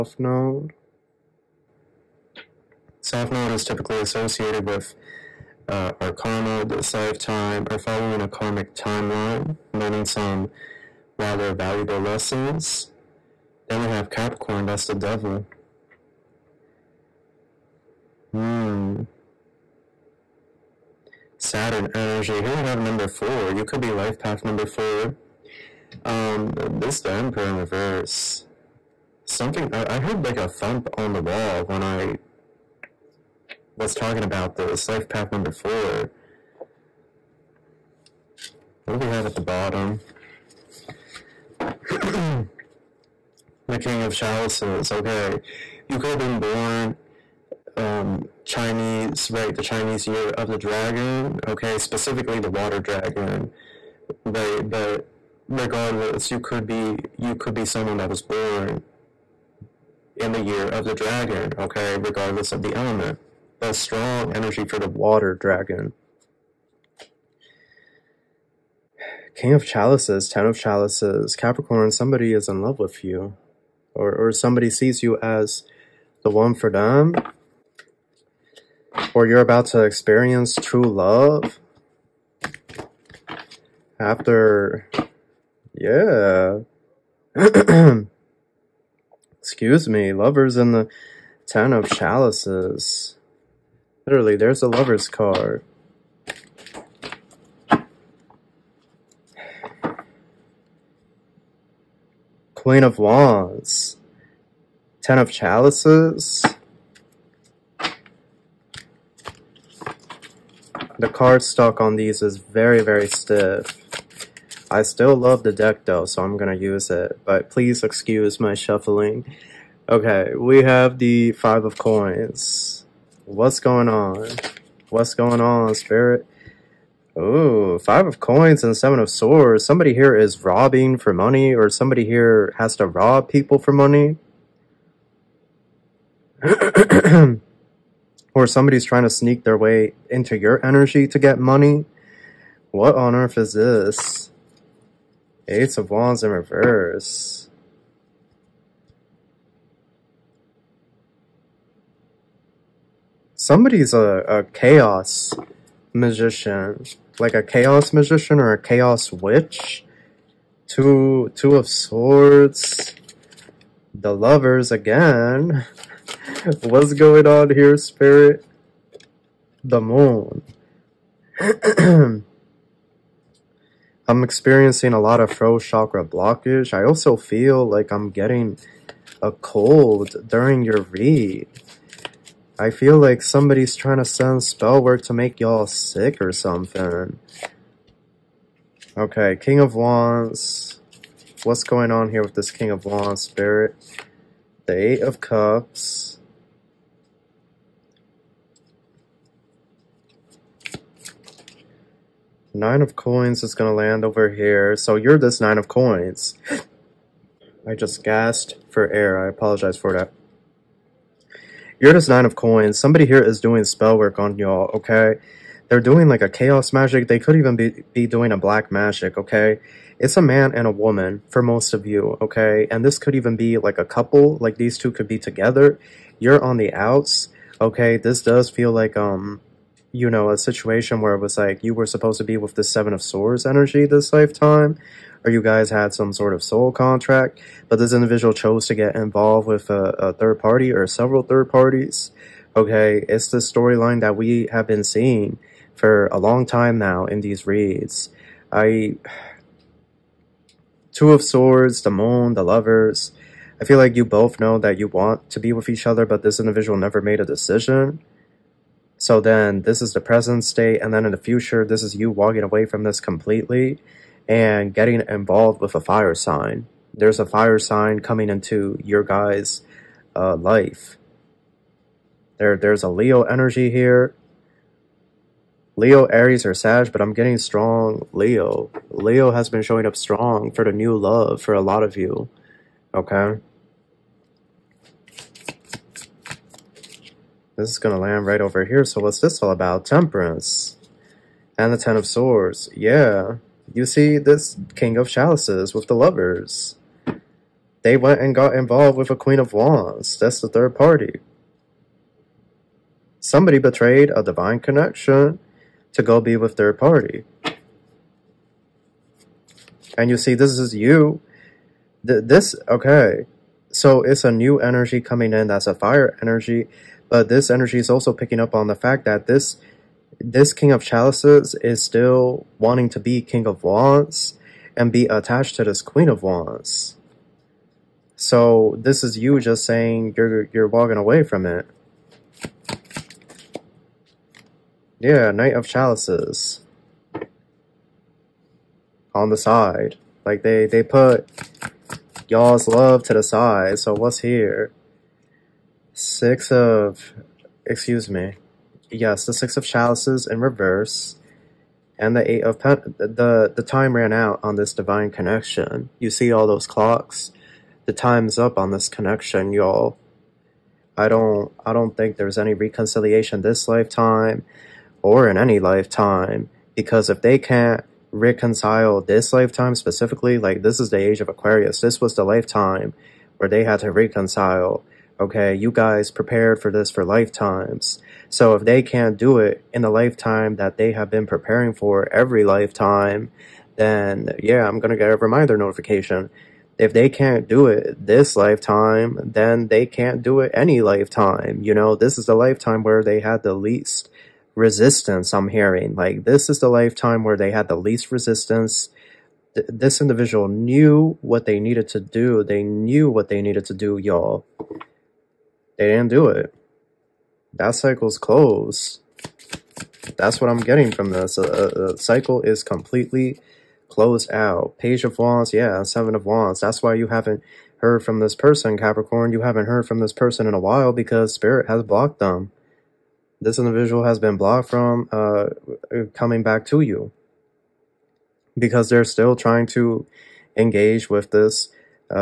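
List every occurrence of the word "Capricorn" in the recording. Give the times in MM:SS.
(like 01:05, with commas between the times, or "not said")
00:14, 01:11, 06:58.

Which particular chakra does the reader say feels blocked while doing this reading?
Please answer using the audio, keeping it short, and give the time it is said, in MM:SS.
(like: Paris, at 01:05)
Throat chakra, at 02:55.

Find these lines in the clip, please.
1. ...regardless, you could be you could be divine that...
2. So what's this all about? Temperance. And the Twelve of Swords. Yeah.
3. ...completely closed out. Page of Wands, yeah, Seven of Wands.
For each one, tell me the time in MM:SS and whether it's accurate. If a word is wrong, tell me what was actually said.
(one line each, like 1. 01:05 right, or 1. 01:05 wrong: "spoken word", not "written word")
1. 00:55 wrong: "someone", not "divine"
2. 04:48 wrong: "Ten", not "Twelve"
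3. 06:52 right.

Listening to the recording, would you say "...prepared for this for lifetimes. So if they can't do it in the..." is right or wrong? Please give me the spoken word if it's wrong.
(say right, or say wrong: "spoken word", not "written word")
right.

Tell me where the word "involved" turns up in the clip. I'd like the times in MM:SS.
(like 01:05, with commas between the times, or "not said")
03:58, 04:25, 04:58.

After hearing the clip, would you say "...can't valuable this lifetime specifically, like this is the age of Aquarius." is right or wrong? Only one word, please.
wrong.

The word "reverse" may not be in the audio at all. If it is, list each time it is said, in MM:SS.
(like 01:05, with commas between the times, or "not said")
00:27, 02:26, 05:50.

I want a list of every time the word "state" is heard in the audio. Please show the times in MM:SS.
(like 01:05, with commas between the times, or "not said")
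04:20.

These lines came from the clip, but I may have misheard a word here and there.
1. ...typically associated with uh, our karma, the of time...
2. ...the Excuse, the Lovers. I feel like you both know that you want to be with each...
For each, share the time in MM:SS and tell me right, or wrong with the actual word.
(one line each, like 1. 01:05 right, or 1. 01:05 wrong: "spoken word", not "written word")
1. 00:03 right
2. 04:11 wrong: "Moon", not "Excuse".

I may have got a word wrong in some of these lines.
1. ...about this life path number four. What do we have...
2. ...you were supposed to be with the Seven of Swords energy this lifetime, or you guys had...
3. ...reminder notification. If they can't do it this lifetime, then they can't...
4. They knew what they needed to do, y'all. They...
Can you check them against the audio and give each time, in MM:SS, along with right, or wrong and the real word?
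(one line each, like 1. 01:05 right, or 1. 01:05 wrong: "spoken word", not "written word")
1. 00:34 right
2. 03:51 right
3. 06:25 right
4. 06:42 right.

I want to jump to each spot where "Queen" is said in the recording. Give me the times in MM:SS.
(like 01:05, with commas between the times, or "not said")
01:42, 04:59, 05:25.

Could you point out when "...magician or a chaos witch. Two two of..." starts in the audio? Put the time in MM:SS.
02:37.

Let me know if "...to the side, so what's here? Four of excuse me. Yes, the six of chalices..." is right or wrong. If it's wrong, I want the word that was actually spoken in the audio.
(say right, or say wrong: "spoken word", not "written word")
wrong: "Six", not "Four".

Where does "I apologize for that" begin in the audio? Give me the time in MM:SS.
03:29.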